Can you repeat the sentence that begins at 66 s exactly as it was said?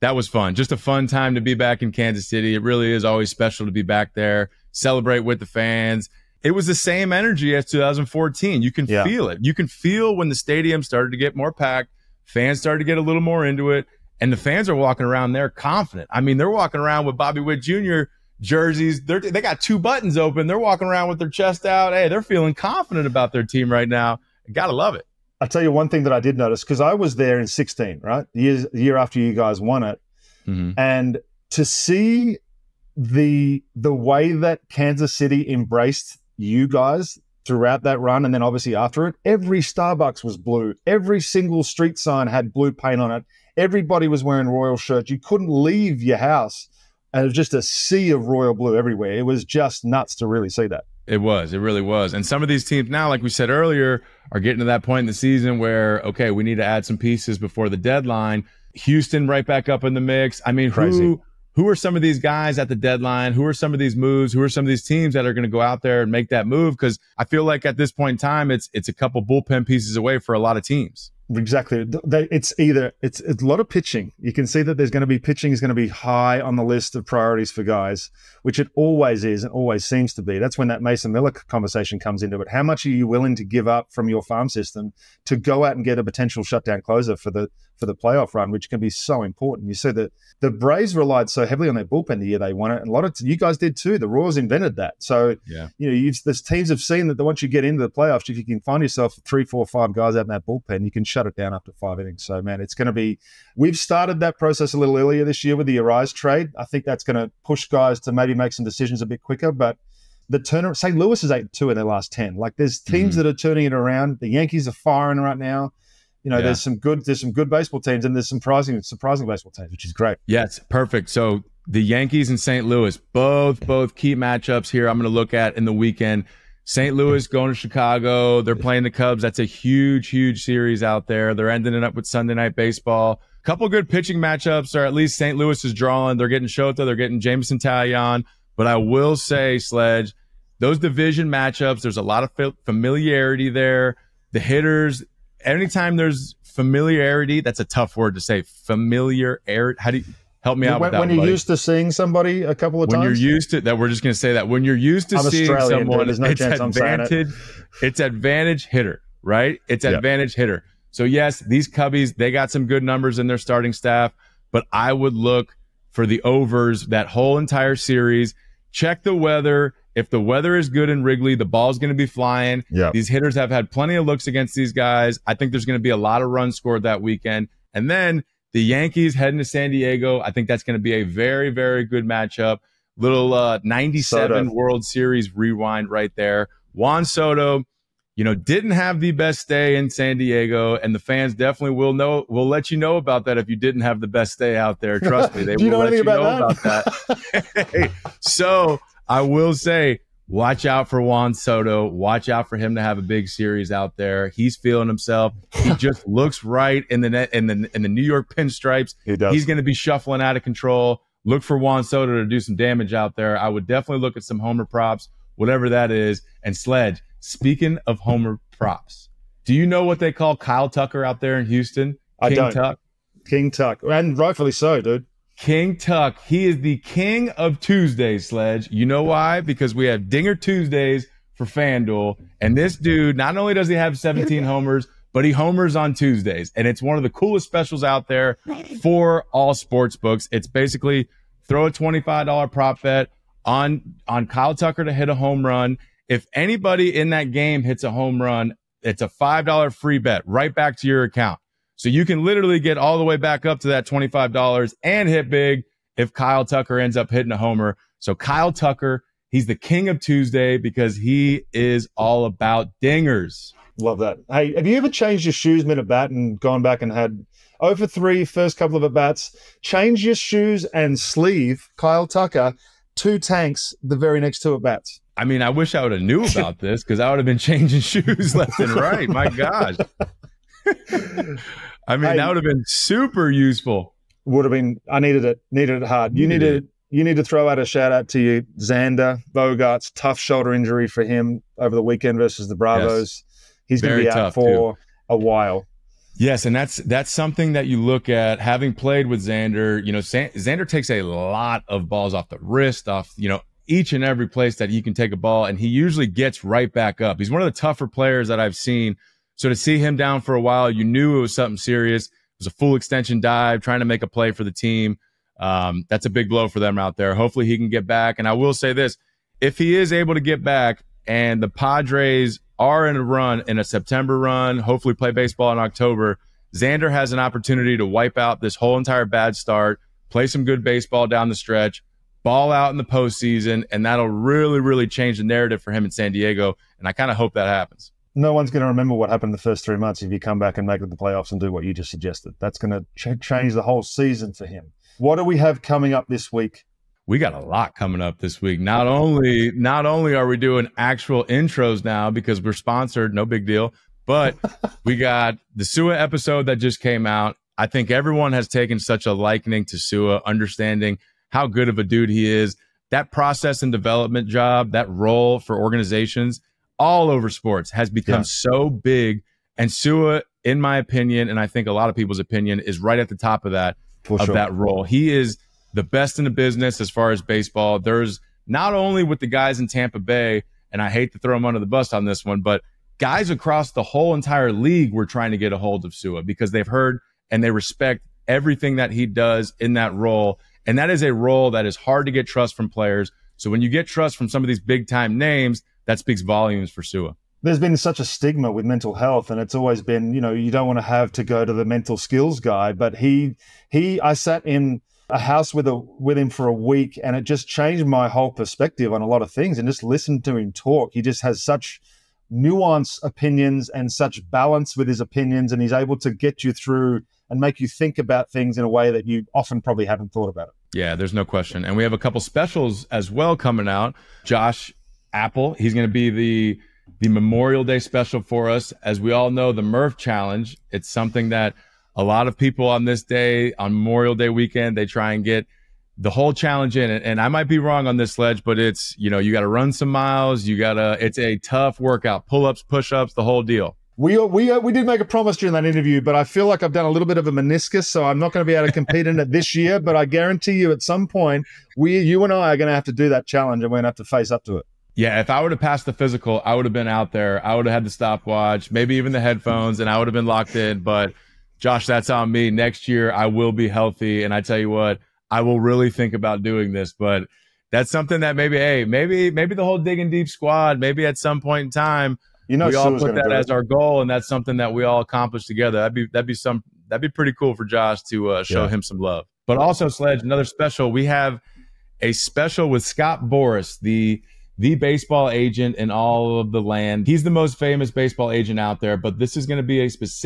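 Because I feel like at this point in time, it's it's a couple bullpen pieces away for a lot of teams.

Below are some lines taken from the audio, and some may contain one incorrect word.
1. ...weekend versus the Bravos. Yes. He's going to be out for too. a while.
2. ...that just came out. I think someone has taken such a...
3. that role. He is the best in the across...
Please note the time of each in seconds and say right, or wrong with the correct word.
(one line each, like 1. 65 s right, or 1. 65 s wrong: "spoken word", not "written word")
1. 291 s right
2. 356 s wrong: "everyone", not "someone"
3. 374 s wrong: "business", not "across".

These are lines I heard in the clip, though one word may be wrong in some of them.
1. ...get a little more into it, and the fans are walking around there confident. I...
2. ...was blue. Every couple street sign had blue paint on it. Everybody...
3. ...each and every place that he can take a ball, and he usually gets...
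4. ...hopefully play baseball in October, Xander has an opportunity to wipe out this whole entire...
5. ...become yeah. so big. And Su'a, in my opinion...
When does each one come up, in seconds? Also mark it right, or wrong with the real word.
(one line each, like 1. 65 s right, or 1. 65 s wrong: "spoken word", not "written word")
1. 12 s right
2. 40 s wrong: "single", not "couple"
3. 303 s right
4. 324 s right
5. 367 s right.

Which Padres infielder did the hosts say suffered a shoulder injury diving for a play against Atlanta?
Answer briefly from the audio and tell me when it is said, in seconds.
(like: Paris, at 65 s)
Xander Bogaerts, at 288 s.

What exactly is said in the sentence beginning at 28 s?
The year, the year after you guys won it.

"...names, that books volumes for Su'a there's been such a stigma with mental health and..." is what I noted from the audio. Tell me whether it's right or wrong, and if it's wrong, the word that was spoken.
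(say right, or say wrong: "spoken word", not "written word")
wrong: "speaks", not "books".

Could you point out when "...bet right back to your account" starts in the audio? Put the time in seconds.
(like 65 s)
249 s.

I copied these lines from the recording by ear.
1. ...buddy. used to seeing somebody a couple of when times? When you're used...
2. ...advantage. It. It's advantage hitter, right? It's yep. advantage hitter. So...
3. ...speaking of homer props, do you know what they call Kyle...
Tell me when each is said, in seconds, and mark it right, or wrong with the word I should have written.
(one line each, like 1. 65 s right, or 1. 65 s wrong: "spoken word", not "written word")
1. 151 s right
2. 156 s right
3. 217 s right.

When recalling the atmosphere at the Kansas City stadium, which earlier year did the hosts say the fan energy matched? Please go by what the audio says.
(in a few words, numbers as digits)
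2014.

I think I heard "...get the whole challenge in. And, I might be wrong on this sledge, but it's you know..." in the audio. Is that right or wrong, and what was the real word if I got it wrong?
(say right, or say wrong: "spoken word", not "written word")
right.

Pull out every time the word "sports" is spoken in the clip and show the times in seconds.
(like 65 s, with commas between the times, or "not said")
239 s, 367 s.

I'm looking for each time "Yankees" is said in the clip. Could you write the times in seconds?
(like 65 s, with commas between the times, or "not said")
114 s, 121 s, 178 s.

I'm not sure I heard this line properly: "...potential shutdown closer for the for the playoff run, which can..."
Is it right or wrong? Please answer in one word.
right.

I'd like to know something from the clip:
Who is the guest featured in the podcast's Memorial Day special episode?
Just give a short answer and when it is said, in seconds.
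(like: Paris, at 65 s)
Josh Appel, at 424 s.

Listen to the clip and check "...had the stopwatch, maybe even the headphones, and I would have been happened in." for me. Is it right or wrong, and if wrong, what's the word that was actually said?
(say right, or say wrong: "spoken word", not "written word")
wrong: "locked", not "happened".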